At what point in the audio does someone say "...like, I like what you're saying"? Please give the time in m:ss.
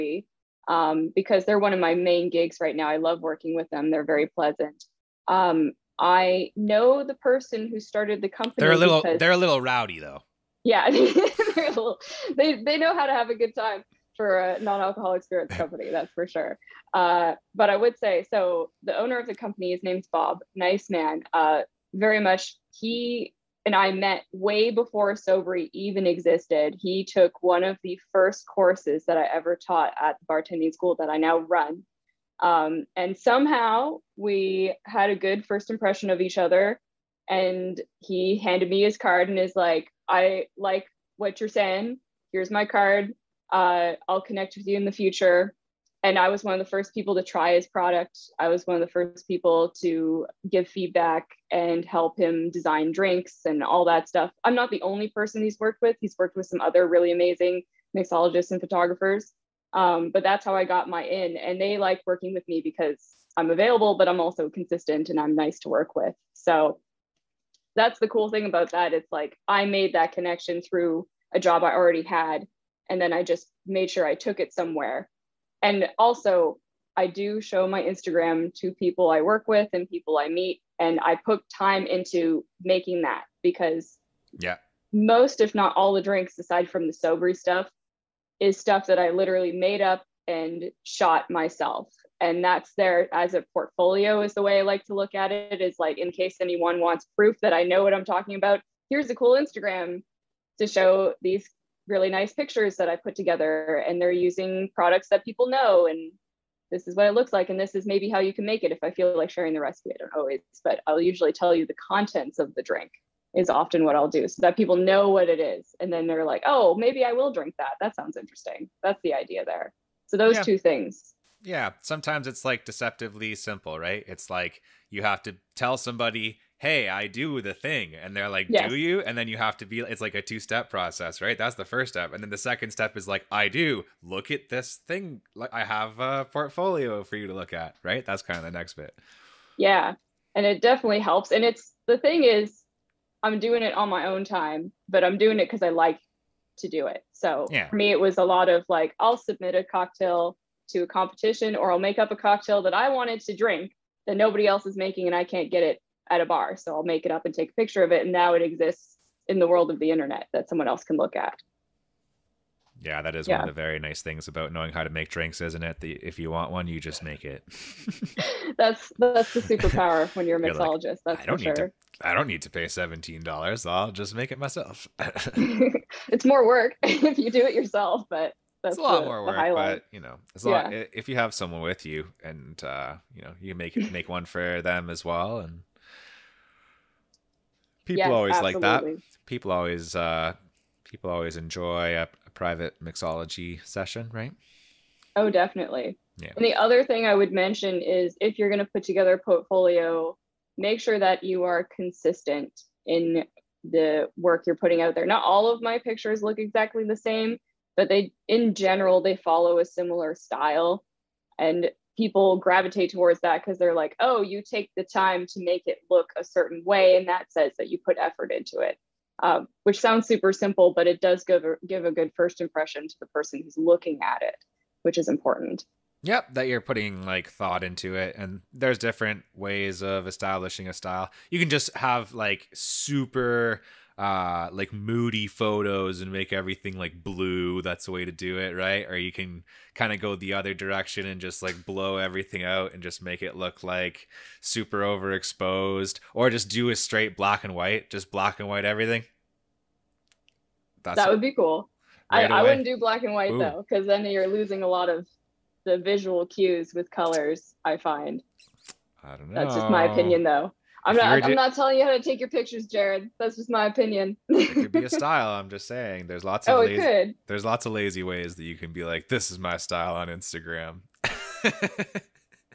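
0:39.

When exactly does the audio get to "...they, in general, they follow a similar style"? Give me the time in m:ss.
3:27.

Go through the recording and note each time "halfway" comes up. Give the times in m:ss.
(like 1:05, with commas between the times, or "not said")
not said.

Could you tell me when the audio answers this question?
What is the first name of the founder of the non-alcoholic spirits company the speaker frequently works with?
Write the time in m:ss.
0:20.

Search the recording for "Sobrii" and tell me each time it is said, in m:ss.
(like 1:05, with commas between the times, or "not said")
0:25, 1:26.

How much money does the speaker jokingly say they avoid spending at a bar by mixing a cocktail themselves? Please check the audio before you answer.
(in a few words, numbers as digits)
$17.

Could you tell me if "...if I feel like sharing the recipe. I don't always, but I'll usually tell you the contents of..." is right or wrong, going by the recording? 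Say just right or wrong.
right.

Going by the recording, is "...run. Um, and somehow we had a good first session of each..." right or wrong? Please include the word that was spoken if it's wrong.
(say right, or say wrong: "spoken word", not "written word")
wrong: "impression", not "session".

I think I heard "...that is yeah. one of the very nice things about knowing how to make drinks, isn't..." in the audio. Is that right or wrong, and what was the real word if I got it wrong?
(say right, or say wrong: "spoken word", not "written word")
right.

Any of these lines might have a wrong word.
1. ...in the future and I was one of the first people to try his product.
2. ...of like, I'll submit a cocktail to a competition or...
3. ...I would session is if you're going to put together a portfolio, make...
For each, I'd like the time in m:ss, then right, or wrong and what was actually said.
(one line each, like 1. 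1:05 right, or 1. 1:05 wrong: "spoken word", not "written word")
1. 0:44 right
2. 2:28 right
3. 3:17 wrong: "mention", not "session".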